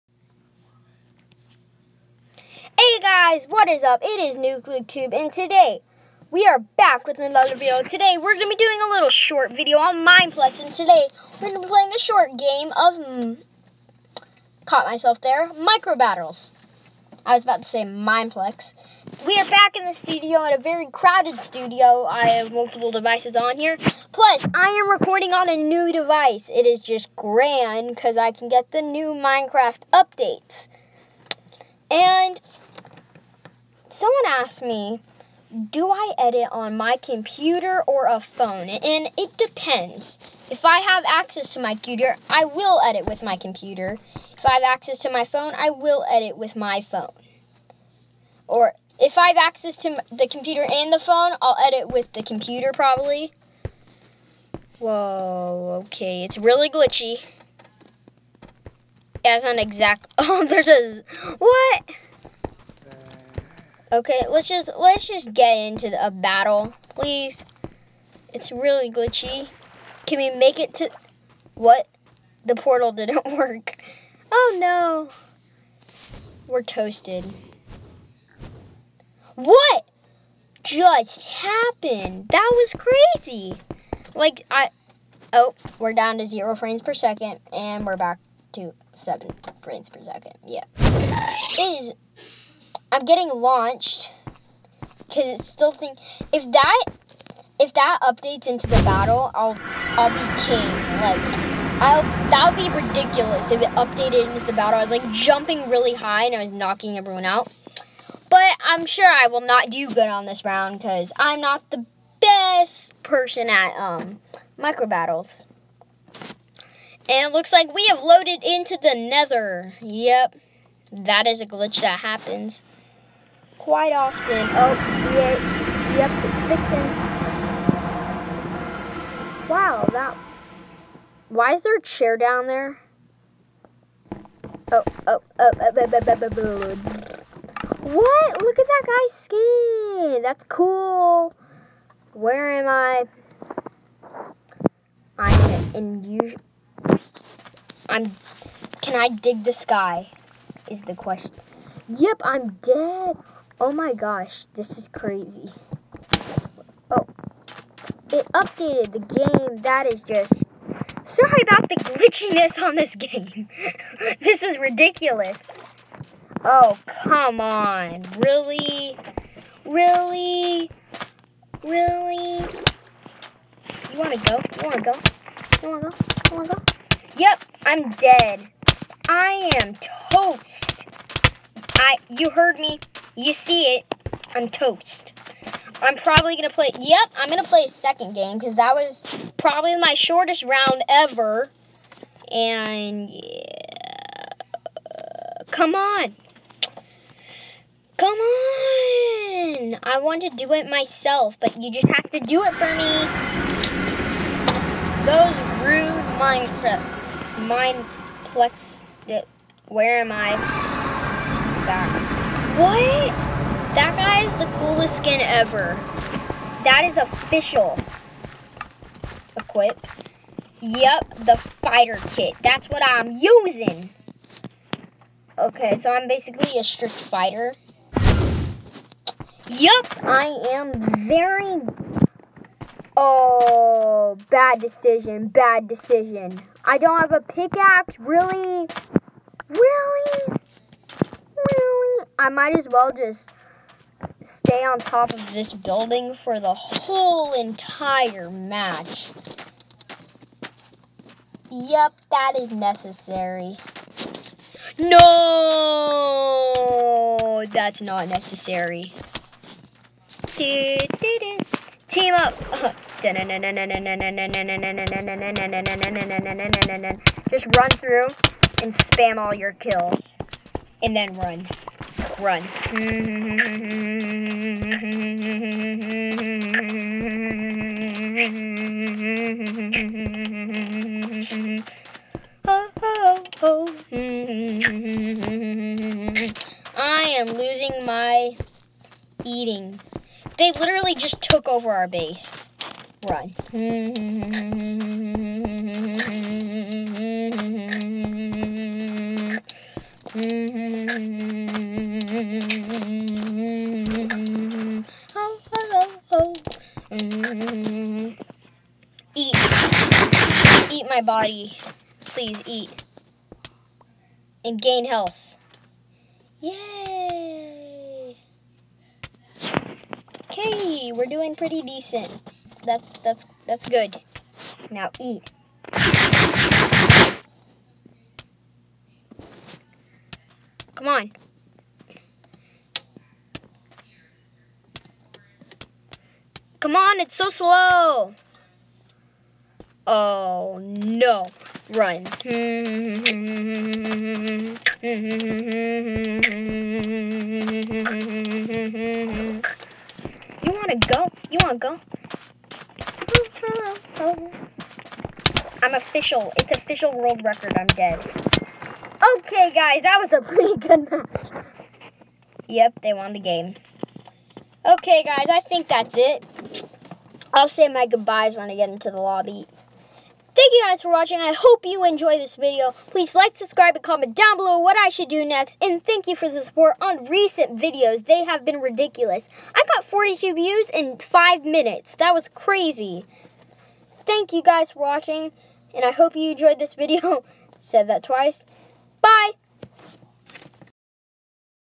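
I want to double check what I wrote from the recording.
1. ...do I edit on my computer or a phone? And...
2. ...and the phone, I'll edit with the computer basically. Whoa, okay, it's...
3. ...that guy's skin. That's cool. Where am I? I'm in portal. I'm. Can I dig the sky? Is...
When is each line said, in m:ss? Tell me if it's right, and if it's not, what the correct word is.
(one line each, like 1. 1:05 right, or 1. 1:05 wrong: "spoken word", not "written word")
1. 0:35 right
2. 0:50 wrong: "probably", not "basically"
3. 2:18 wrong: "unusual", not "portal".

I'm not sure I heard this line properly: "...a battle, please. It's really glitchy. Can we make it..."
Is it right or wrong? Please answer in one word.
right.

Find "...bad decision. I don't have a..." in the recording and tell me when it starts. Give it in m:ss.
3:55.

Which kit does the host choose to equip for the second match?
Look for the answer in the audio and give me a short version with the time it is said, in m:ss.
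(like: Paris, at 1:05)
fighter kit, at 3:41.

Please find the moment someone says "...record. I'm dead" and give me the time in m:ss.
5:57.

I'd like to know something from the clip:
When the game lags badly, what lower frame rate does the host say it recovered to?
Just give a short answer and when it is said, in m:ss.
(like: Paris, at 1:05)
7 frames per second, at 1:28.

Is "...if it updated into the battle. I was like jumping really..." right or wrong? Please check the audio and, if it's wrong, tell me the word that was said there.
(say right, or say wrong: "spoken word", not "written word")
right.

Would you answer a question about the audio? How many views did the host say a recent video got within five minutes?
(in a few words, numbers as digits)
42.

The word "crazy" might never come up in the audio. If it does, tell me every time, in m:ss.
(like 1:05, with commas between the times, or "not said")
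1:22, 2:34, 6:22.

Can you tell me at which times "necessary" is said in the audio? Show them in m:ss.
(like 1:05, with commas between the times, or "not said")
4:12, 4:18.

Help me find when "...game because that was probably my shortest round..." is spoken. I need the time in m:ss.
3:08.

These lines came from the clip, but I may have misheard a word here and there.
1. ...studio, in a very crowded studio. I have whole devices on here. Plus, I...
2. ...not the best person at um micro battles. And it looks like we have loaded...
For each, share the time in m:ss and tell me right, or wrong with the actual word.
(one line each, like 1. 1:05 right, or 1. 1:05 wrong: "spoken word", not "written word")
1. 0:19 wrong: "multiple", not "whole"
2. 1:51 right.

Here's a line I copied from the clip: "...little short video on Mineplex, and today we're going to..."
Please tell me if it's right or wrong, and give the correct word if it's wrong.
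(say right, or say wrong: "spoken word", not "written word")
right.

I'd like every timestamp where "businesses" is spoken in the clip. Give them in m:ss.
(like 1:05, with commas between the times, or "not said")
not said.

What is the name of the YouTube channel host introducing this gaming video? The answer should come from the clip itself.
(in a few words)
NucleTube.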